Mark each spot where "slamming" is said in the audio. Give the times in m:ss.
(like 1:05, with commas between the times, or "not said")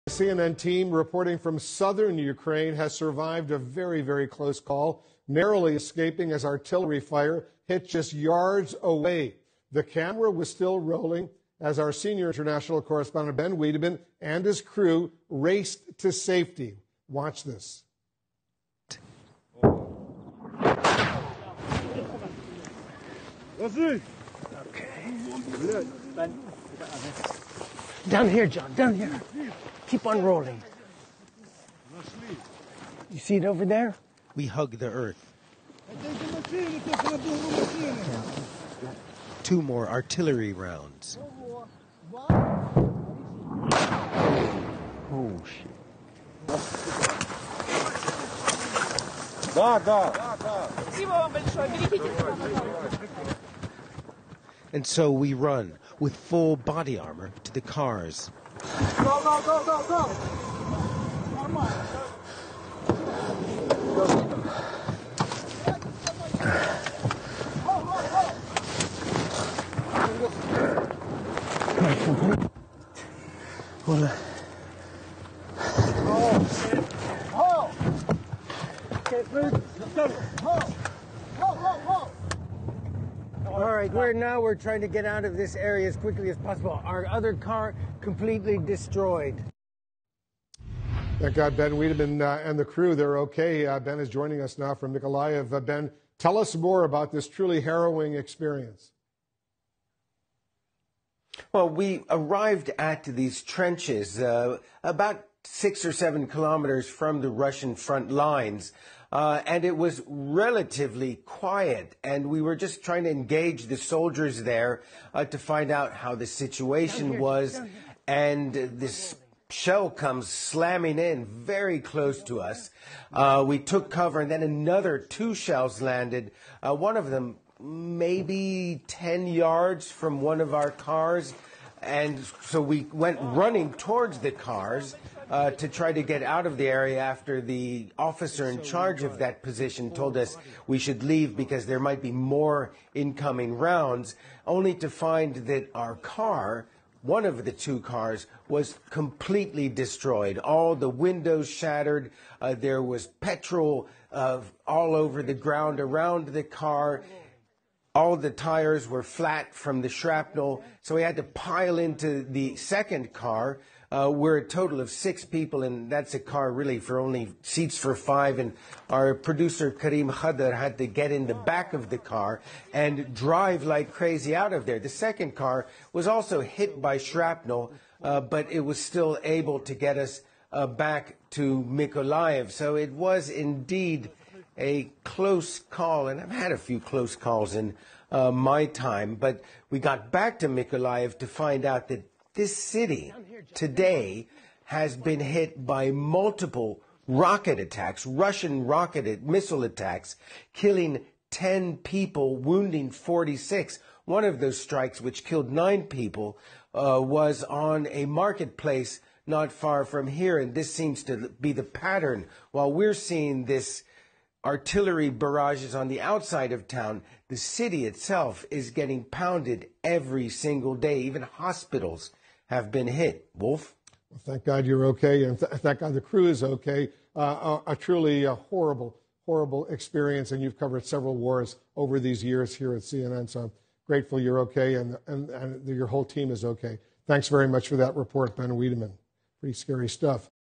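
2:00.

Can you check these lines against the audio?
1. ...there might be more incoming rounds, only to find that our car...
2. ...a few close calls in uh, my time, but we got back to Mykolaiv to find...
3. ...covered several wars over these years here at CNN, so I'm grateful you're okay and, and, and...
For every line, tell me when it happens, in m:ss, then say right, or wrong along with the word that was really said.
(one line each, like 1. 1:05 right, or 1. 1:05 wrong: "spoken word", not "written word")
1. 2:21 right
2. 3:06 right
3. 3:50 right.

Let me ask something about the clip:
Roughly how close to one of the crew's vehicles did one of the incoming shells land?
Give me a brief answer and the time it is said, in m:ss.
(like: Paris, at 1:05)
10 yards, at 2:08.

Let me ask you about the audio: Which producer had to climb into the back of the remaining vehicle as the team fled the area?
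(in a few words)
Kareem Khadder.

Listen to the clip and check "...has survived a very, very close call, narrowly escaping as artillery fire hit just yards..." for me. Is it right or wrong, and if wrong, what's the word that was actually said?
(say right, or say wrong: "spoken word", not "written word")
right.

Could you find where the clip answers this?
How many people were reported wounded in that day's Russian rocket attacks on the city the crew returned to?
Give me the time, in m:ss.
3:22.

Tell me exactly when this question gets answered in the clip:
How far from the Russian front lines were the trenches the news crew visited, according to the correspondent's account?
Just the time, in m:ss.
1:45.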